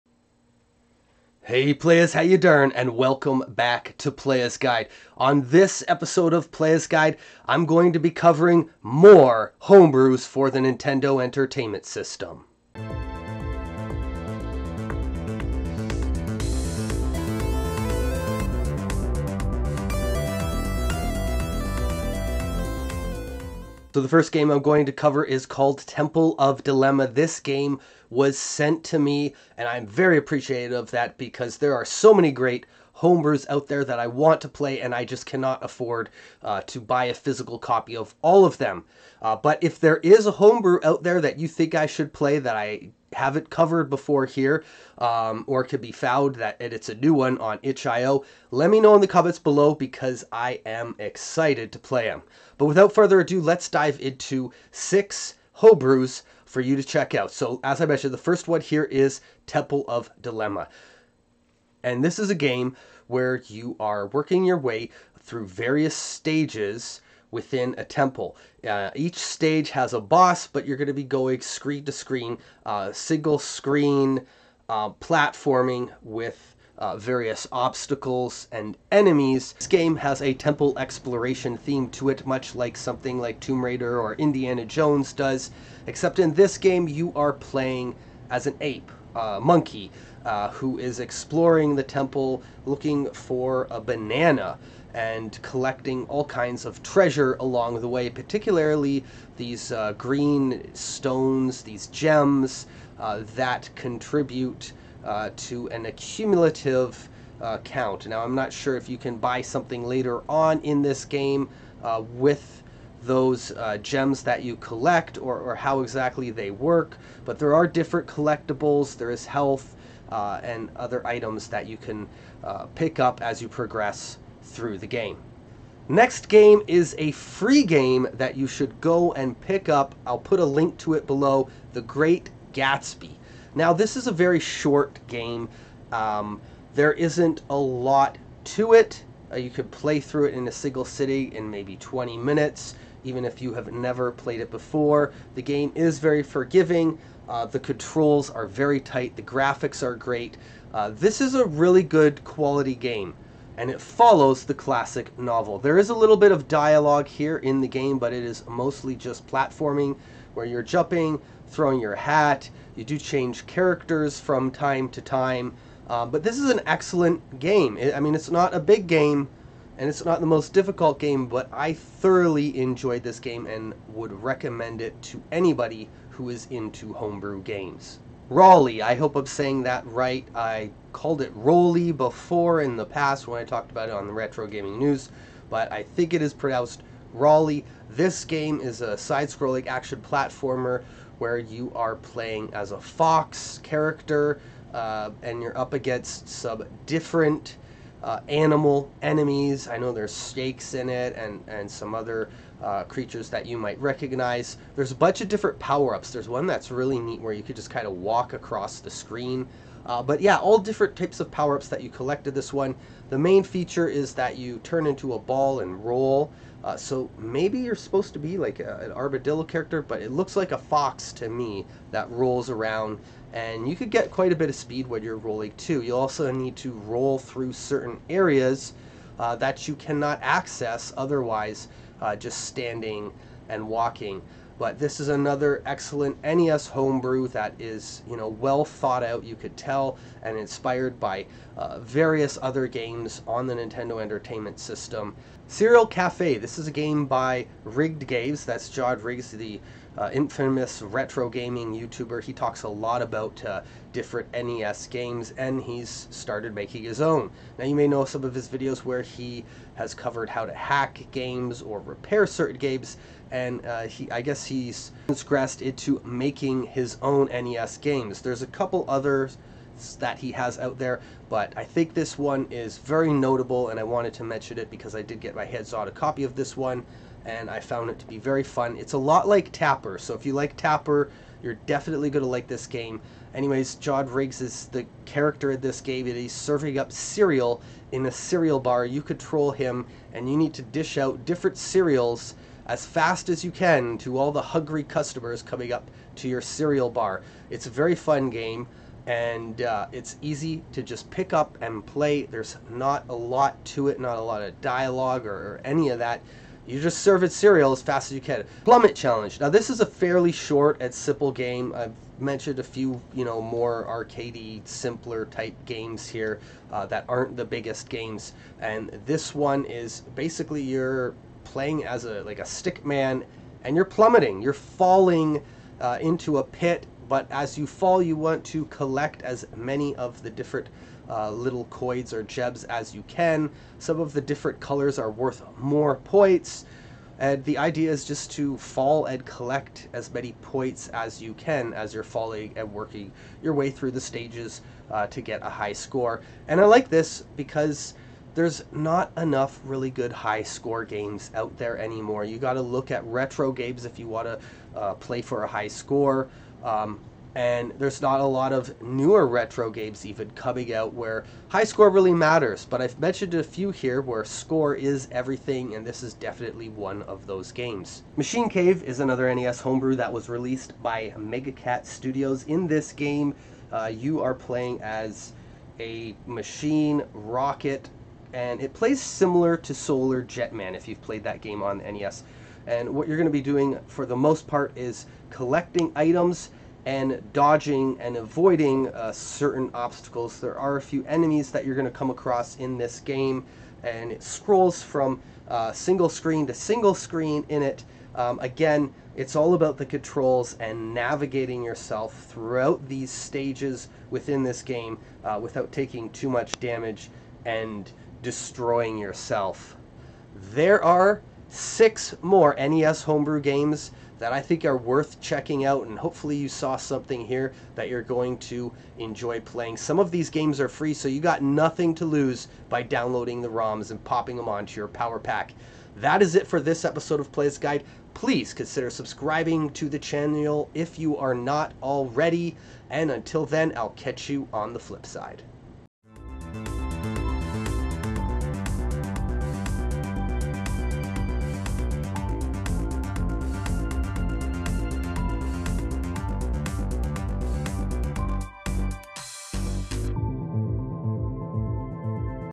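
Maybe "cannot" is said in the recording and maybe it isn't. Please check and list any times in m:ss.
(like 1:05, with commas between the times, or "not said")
0:35, 3:49.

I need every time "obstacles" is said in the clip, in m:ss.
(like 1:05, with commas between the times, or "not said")
1:17, 6:29.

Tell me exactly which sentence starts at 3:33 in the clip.
The main feature is that you turn into a ball and roll.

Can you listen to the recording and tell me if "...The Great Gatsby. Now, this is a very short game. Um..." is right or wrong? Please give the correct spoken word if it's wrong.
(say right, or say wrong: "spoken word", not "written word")
right.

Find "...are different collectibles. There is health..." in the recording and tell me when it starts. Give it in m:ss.
1:57.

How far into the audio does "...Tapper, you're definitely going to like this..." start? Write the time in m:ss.
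4:40.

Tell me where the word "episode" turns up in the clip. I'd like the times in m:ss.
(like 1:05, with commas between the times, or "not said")
0:05, 7:06.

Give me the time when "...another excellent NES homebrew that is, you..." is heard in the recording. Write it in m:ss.
3:55.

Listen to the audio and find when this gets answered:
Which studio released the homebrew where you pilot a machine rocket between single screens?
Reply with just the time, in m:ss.
6:11.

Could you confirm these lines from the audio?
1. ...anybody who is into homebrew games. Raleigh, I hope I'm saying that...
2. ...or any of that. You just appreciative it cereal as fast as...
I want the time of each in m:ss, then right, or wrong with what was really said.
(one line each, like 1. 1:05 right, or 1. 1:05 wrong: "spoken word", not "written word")
1. 2:55 right
2. 5:05 wrong: "serve", not "appreciative".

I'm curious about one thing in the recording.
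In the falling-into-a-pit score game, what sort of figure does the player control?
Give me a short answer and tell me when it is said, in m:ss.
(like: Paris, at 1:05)
A stick man, at 5:22.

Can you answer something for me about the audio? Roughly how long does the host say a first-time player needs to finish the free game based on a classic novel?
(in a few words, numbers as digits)
20 minutes.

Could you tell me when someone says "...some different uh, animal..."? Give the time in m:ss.
3:16.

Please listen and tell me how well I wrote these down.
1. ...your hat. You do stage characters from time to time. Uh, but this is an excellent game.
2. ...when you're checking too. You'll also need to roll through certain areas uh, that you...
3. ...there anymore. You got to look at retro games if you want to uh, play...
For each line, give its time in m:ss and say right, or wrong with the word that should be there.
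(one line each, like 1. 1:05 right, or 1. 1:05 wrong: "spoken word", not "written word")
1. 2:41 wrong: "change", not "stage"
2. 3:44 wrong: "rolling", not "checking"
3. 5:51 right.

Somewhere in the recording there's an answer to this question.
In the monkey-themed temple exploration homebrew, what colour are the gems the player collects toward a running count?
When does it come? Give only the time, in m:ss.
1:39.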